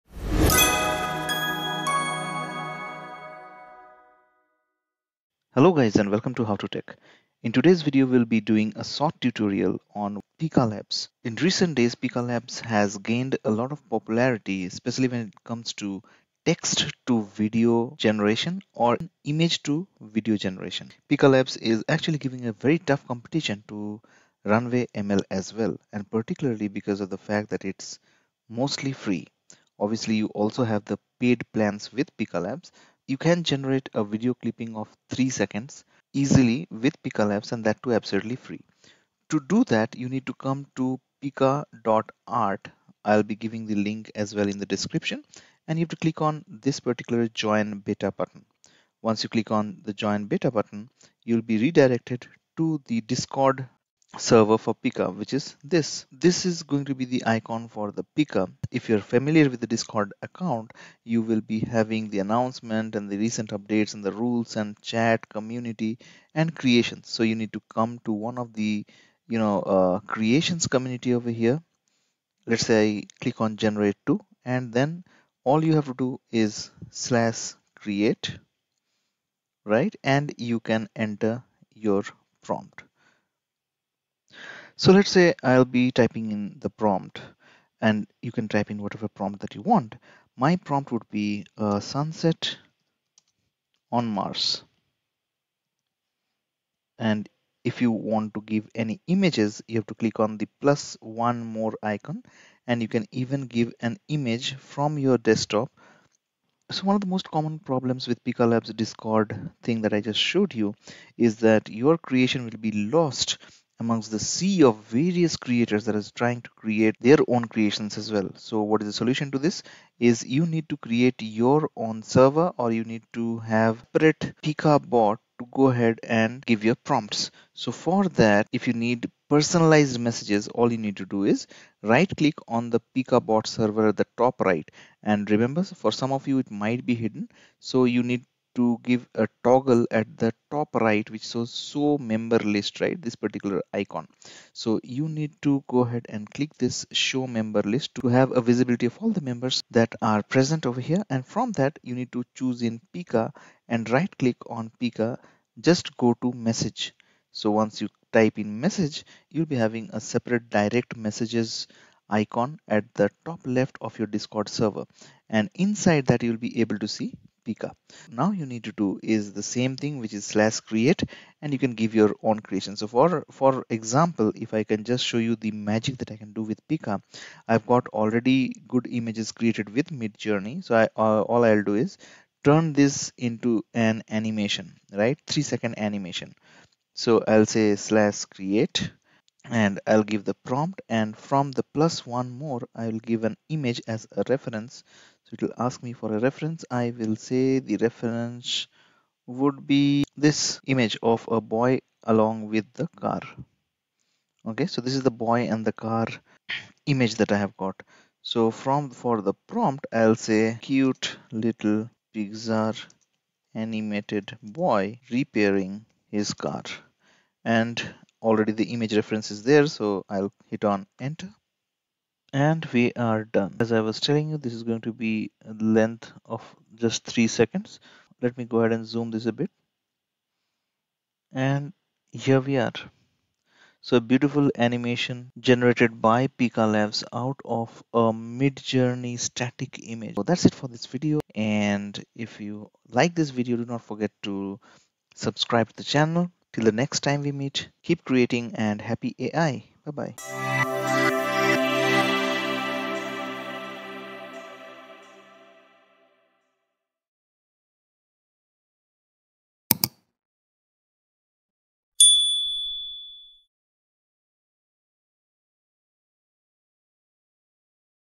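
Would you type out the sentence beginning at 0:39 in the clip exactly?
To do that, you need to come to pika.art.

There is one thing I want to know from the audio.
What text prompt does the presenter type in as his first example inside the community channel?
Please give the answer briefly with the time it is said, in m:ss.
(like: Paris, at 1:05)
Sunset on Mars, at 1:31.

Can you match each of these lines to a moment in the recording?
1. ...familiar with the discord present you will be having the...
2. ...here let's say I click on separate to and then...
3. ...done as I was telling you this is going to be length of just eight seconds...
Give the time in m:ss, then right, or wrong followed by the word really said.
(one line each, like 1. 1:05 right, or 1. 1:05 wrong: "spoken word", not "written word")
1. 0:58 wrong: "account", not "present"
2. 1:11 wrong: "generate", not "separate"
3. 3:43 wrong: "three", not "eight".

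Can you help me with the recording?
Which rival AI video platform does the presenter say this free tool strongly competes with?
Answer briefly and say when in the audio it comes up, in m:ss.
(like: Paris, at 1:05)
Runway ML, at 0:24.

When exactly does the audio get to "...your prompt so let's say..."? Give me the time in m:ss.
1:21.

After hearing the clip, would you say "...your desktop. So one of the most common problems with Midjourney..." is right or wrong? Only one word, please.
wrong.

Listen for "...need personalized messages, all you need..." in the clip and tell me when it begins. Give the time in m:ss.
2:08.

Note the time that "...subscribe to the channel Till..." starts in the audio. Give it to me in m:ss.
4:05.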